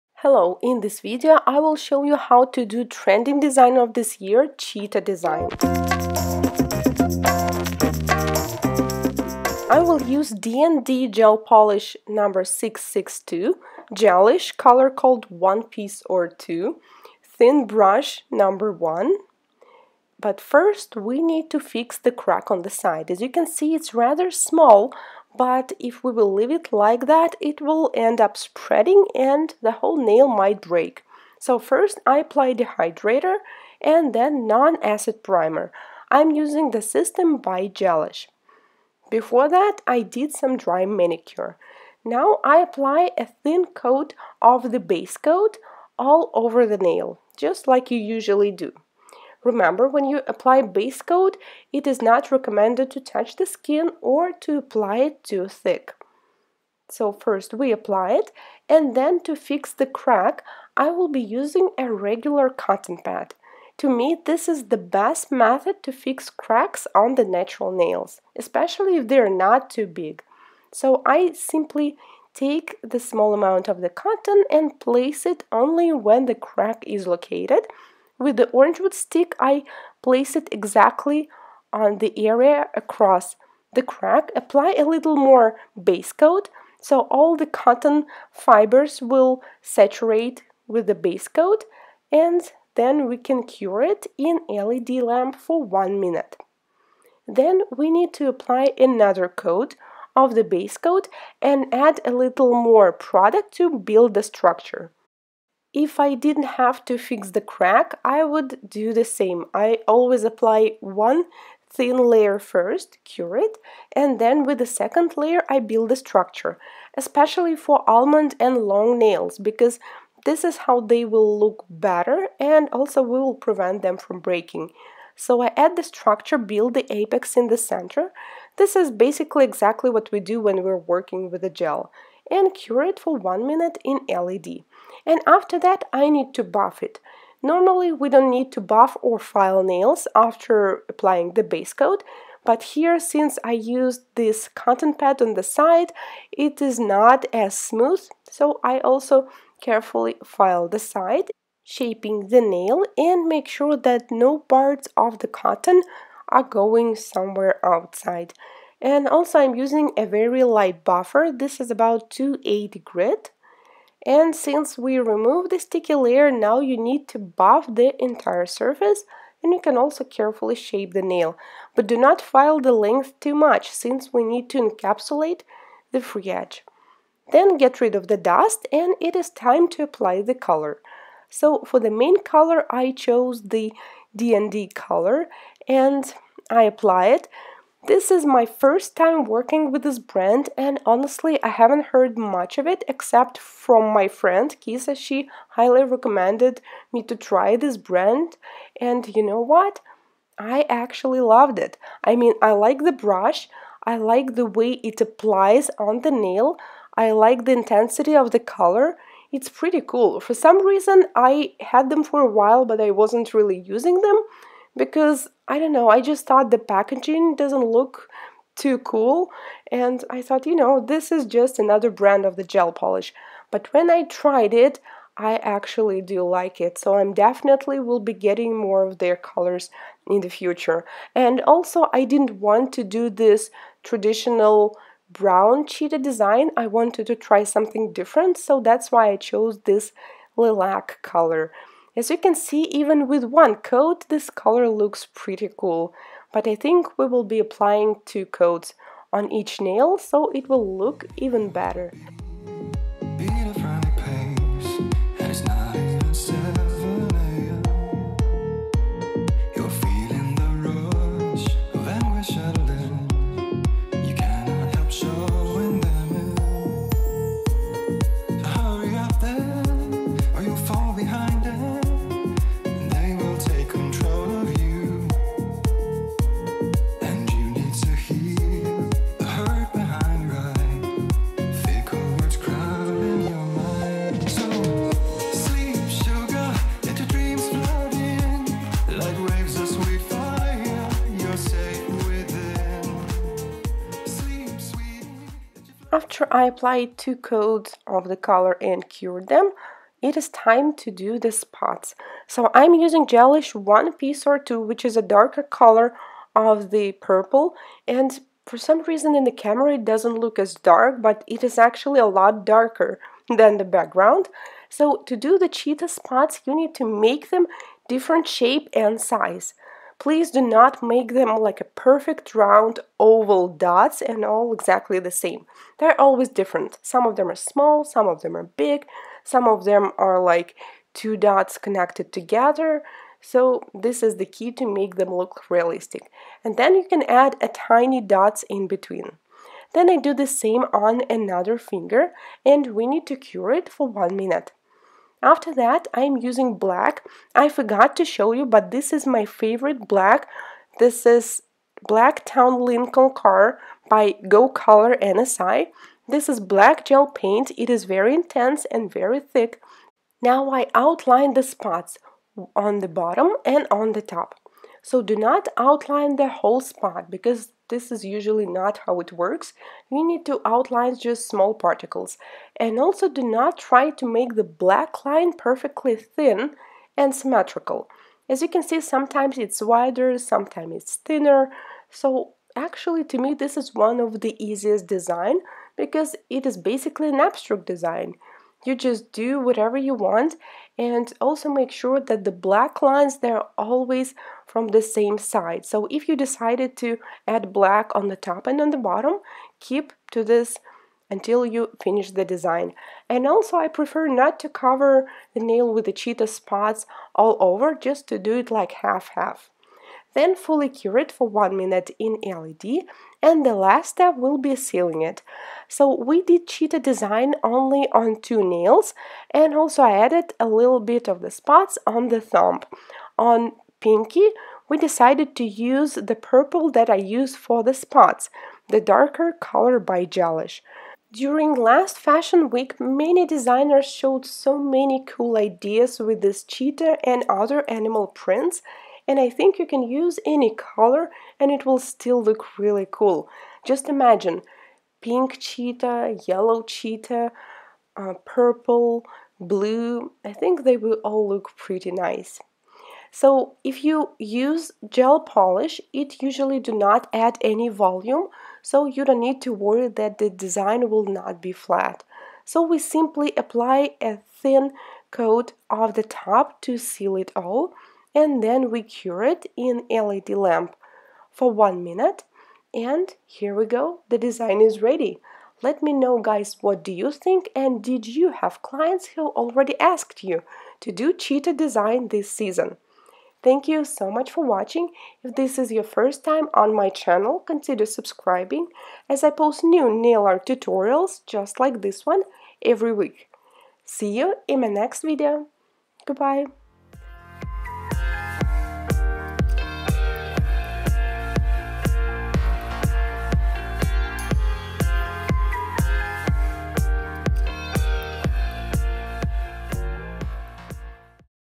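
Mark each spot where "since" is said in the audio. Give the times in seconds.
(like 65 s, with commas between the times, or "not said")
142 s, 164 s, 173 s.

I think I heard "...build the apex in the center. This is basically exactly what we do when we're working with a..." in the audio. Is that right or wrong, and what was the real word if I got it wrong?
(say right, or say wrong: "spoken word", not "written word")
right.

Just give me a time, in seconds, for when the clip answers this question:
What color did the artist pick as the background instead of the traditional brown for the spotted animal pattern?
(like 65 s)
240 s.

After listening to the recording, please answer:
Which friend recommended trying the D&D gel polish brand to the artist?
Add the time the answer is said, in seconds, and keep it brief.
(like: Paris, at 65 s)
Kisa, at 194 s.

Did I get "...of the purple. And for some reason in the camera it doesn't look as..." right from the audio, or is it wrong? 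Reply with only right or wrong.
right.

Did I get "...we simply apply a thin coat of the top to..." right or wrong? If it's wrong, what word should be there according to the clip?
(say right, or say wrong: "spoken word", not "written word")
right.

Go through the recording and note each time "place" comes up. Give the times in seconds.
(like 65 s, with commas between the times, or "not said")
74 s, 80 s.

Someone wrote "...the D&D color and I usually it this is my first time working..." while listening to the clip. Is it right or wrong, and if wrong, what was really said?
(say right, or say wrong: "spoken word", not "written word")
wrong: "apply", not "usually".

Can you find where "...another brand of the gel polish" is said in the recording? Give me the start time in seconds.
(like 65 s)
221 s.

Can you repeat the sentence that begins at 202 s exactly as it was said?
I mean, I like the brush, I like the way it applies on the nail, I like the intensity of the color.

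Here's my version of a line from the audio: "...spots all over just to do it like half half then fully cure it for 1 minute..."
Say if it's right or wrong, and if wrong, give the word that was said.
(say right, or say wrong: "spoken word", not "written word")
right.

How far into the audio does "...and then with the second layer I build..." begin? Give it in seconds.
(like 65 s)
113 s.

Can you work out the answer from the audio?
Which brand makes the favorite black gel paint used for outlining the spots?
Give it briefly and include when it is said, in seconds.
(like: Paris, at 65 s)
Go Color NSI, at 354 s.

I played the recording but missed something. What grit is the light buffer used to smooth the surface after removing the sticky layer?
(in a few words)
280.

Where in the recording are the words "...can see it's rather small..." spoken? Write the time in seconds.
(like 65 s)
23 s.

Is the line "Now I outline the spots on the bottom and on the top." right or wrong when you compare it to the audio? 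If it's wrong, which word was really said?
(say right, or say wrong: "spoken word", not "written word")
right.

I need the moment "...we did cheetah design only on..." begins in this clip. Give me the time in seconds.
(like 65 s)
415 s.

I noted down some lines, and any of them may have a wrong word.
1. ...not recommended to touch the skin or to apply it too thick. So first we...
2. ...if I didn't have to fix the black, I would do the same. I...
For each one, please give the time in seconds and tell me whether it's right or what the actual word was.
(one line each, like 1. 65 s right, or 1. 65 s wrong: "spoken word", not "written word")
1. 52 s right
2. 105 s wrong: "crack", not "black".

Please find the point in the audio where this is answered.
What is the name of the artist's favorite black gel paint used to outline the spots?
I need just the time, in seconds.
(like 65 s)
351 s.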